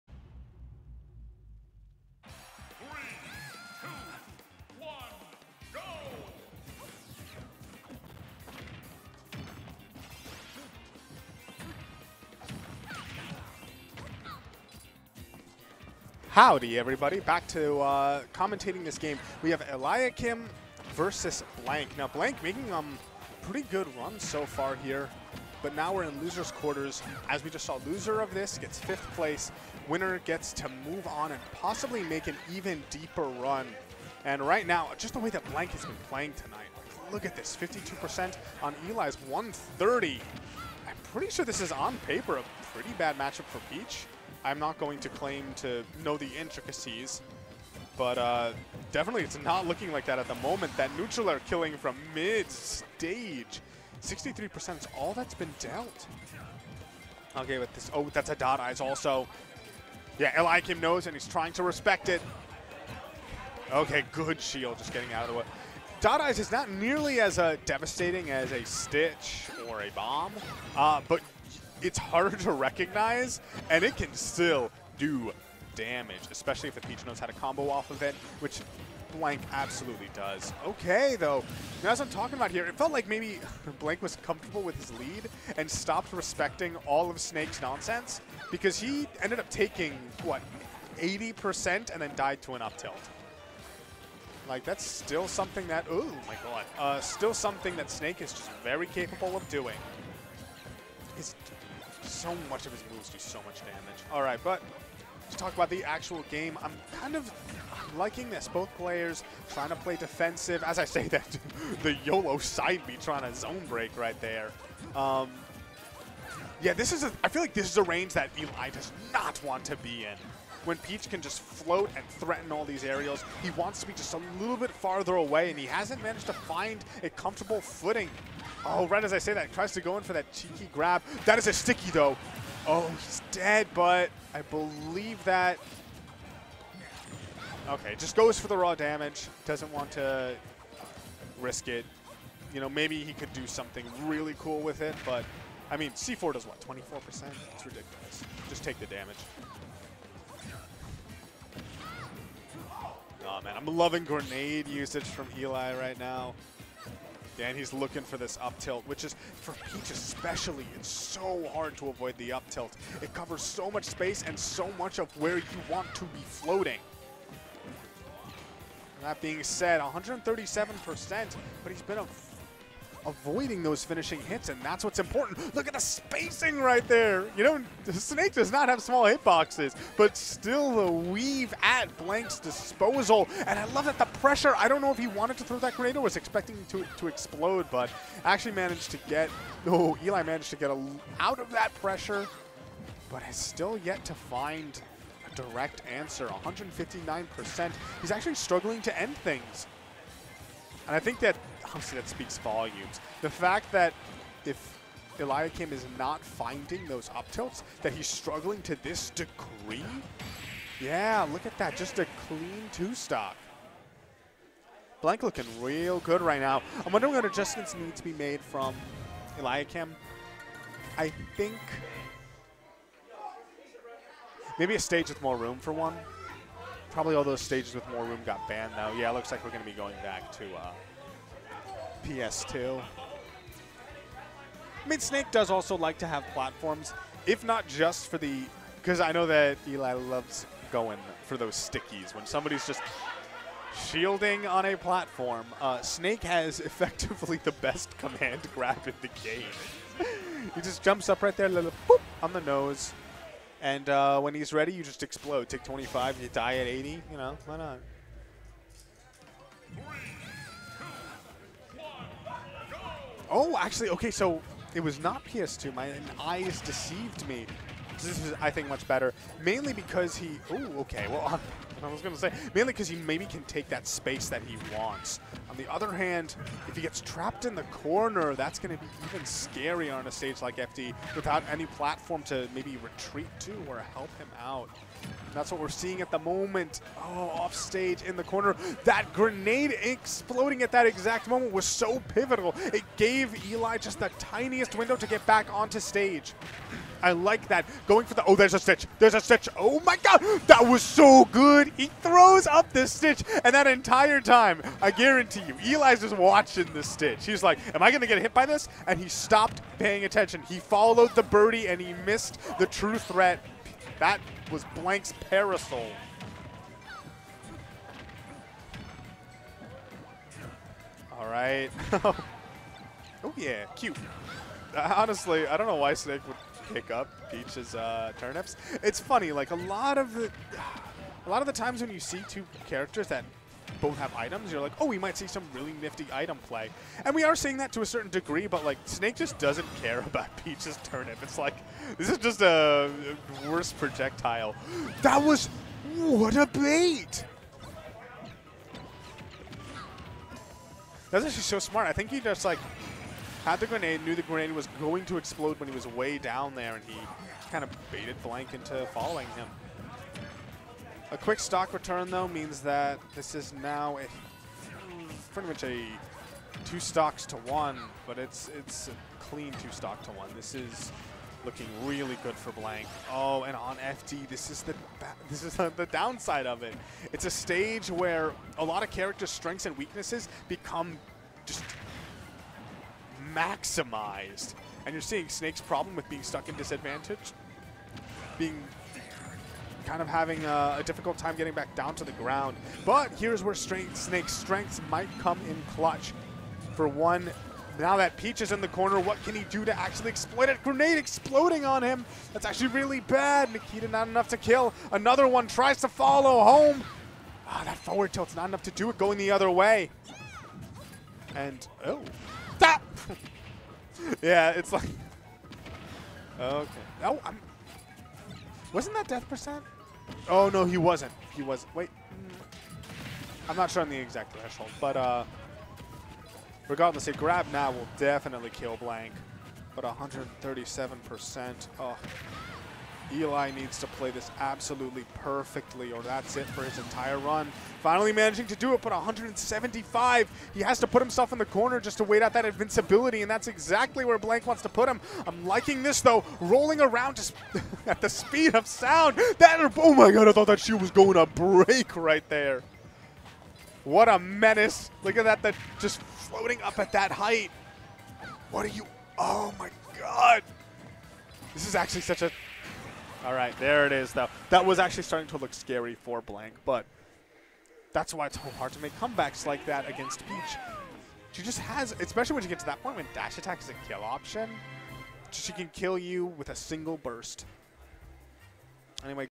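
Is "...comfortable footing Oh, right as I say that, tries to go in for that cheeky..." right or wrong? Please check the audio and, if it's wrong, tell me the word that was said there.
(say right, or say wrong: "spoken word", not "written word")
right.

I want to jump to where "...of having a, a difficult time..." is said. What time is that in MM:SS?
06:30.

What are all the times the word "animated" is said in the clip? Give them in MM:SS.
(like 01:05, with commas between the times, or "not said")
not said.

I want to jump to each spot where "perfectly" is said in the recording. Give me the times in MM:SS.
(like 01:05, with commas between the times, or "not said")
07:15.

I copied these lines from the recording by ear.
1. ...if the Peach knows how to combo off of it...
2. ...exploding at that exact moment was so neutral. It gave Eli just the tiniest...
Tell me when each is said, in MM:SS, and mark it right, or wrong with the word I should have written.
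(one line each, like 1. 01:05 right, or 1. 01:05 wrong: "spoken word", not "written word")
1. 01:16 right
2. 04:49 wrong: "pivotal", not "neutral".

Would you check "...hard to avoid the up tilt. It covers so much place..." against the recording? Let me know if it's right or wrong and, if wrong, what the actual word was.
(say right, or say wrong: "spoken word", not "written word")
wrong: "space", not "place".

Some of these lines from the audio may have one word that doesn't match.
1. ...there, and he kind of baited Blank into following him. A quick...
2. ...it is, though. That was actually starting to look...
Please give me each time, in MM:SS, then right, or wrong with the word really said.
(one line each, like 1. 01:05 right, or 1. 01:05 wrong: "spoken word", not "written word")
1. 05:56 right
2. 07:43 right.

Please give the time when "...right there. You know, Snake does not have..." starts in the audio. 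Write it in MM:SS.
02:56.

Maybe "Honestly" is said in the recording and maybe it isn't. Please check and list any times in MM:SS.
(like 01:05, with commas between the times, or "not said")
03:21, 05:24.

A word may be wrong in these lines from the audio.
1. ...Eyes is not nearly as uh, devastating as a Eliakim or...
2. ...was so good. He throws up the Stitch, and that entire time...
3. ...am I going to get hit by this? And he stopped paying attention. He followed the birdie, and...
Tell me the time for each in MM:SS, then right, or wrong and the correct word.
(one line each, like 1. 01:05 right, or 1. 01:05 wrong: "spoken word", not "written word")
1. 01:06 wrong: "Stitch", not "Eliakim"
2. 05:00 right
3. 05:07 right.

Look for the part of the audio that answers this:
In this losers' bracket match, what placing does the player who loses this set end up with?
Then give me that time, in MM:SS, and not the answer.
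00:28.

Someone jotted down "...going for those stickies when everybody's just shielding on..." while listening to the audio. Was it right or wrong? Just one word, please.
wrong.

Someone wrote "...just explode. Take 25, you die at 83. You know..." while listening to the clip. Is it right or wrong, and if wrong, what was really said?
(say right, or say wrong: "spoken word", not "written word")
wrong: "80", not "83".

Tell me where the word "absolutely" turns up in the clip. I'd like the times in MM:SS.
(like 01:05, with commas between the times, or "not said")
01:19, 07:14.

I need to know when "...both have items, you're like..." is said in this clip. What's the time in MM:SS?
05:33.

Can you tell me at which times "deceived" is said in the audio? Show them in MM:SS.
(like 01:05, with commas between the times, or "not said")
04:26.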